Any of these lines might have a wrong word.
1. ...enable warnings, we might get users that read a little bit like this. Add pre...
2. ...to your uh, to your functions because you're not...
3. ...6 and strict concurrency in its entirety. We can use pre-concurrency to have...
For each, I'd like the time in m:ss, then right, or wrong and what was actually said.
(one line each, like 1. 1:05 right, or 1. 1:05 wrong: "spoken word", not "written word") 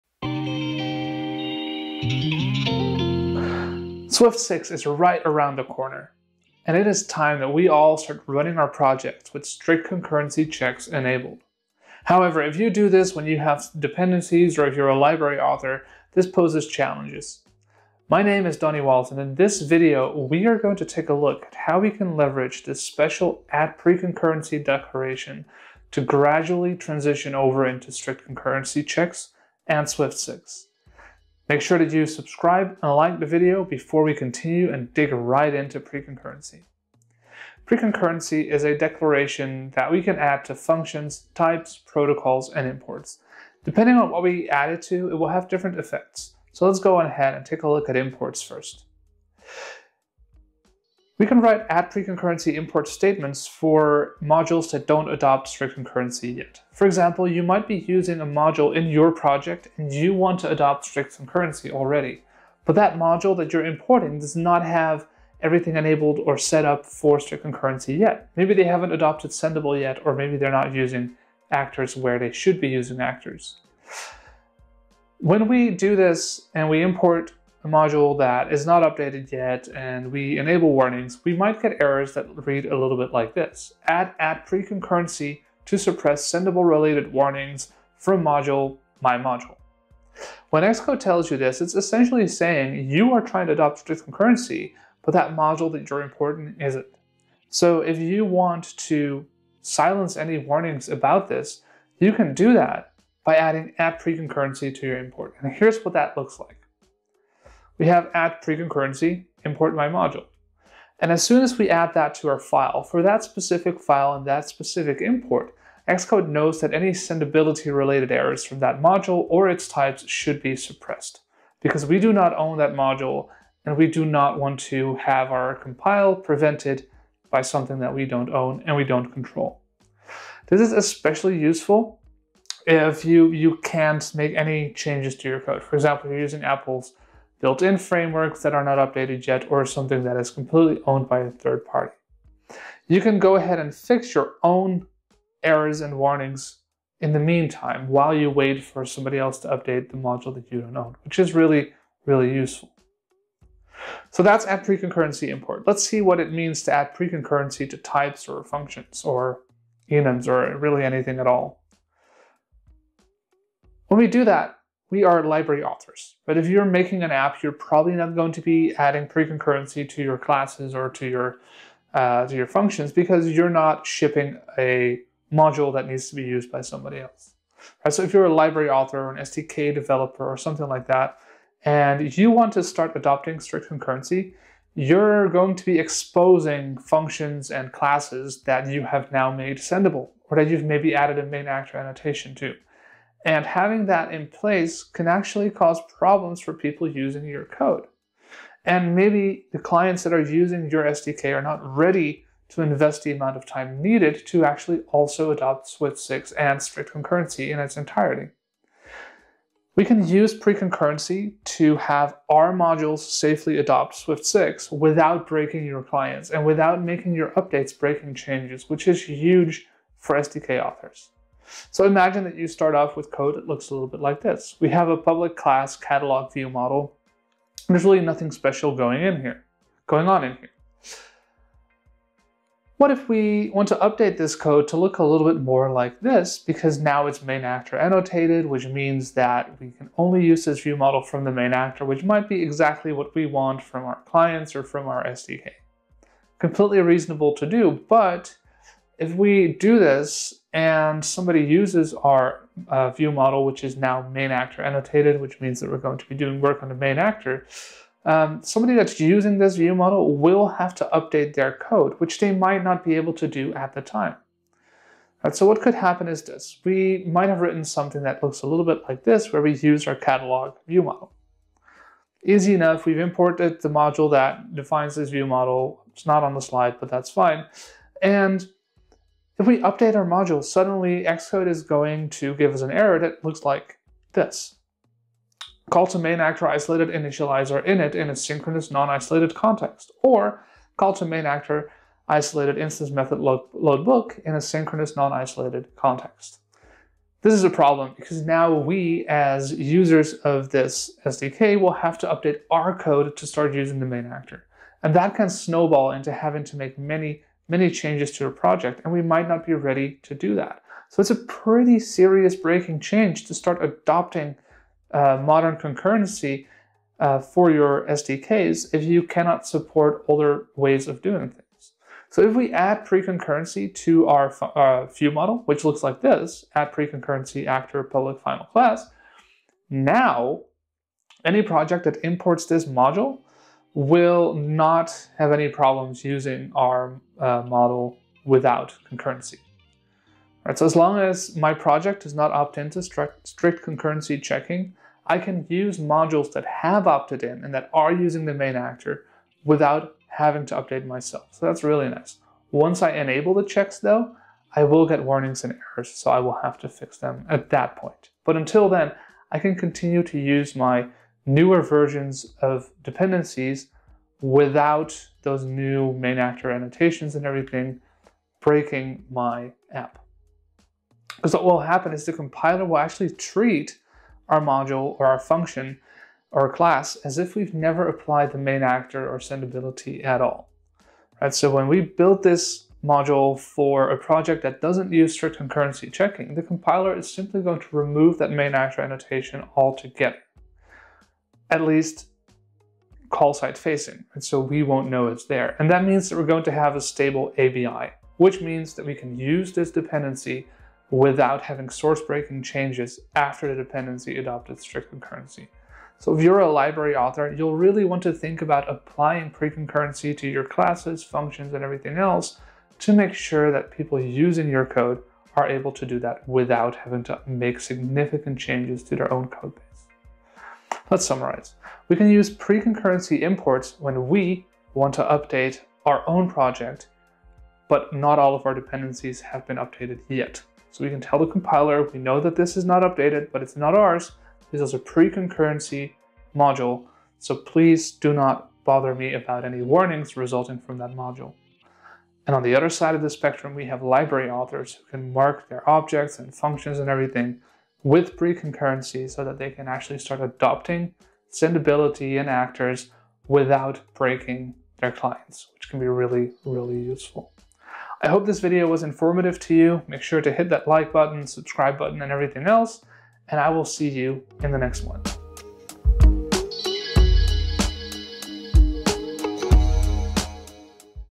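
1. 1:20 wrong: "errors", not "users"
2. 2:50 right
3. 3:25 right.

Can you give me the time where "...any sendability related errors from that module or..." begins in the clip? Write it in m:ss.
1:56.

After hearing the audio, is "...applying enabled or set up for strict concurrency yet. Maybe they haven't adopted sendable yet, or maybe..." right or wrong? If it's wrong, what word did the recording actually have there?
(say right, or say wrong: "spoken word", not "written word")
wrong: "everything", not "applying".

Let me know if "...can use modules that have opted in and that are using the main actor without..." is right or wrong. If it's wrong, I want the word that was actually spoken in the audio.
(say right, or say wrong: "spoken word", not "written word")
right.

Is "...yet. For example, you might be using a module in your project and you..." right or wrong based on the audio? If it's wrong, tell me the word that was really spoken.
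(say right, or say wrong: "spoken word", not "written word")
right.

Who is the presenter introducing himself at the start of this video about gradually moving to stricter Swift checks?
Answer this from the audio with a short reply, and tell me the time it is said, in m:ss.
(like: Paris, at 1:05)
Donny Wals, at 0:18.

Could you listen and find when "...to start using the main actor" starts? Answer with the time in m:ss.
5:03.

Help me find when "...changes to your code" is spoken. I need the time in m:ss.
2:14.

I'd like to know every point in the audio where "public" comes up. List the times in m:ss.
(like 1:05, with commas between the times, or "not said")
3:44, 5:27.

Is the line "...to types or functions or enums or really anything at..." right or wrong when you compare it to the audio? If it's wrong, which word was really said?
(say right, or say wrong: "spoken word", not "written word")
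right.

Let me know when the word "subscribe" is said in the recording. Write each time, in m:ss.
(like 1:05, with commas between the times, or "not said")
0:32, 7:41.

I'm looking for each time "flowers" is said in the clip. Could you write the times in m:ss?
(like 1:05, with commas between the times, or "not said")
not said.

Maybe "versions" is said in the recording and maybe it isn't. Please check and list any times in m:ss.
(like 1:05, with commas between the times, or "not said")
6:01.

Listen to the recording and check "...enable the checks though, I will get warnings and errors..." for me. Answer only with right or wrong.
right.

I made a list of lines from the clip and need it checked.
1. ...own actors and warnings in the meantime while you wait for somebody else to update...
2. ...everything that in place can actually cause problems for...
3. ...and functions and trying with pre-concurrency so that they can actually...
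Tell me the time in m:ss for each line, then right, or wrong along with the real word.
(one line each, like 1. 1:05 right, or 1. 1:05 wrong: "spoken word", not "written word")
1. 2:24 wrong: "errors", not "actors"
2. 3:13 wrong: "having", not "everything"
3. 7:26 wrong: "everything", not "trying".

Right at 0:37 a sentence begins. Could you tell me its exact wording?
Pre- concurrency is a declaration that we can add to functions, types, protocols, and imports.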